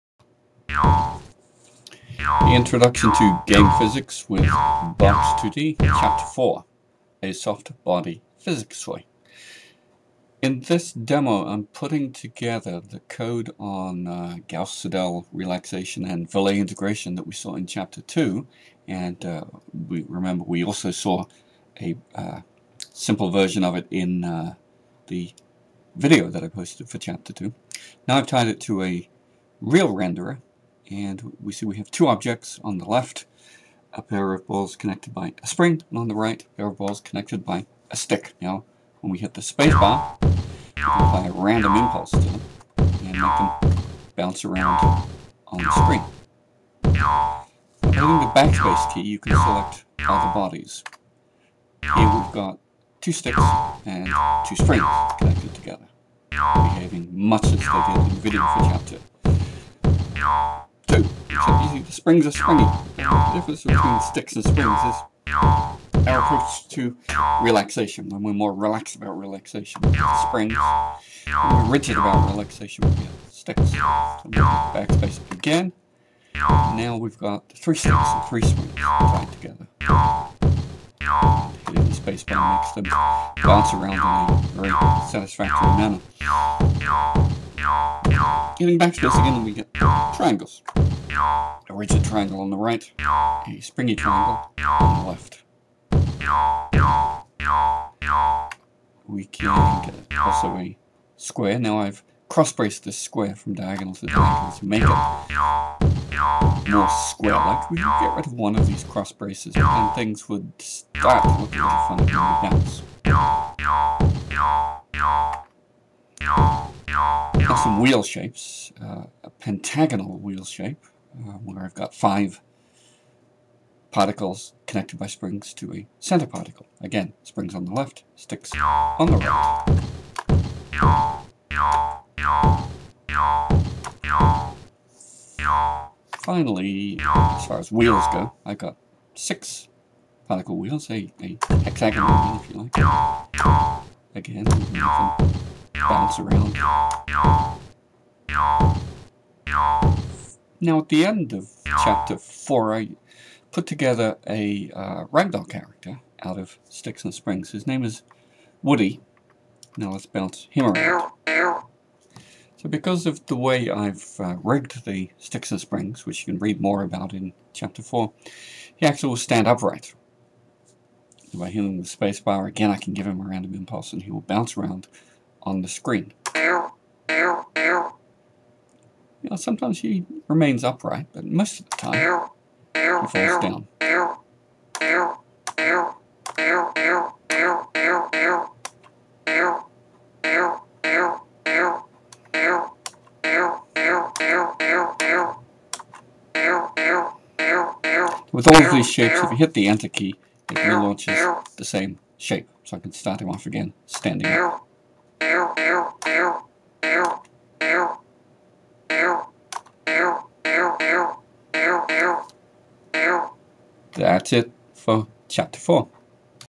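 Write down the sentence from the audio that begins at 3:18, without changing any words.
With all of these shapes, if you hit the enter key, it relaunches the same shape.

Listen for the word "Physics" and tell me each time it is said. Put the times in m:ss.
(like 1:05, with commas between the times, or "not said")
0:03, 0:08.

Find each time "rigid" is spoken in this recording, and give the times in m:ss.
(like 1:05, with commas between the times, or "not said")
1:11, 1:31.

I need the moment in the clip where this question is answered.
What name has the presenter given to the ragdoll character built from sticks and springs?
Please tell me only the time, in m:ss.
2:38.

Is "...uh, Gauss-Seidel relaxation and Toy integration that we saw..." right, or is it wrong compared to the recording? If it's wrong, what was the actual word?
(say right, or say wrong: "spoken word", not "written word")
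wrong: "Verlet", not "Toy".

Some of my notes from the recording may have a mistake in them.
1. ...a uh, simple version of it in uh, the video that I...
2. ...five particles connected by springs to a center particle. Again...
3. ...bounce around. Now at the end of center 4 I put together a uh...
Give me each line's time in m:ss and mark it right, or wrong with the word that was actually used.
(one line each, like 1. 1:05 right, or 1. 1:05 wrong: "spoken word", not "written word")
1. 0:21 right
2. 2:01 right
3. 2:25 wrong: "chapter", not "center".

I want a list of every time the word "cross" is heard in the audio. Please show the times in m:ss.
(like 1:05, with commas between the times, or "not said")
1:42, 1:48.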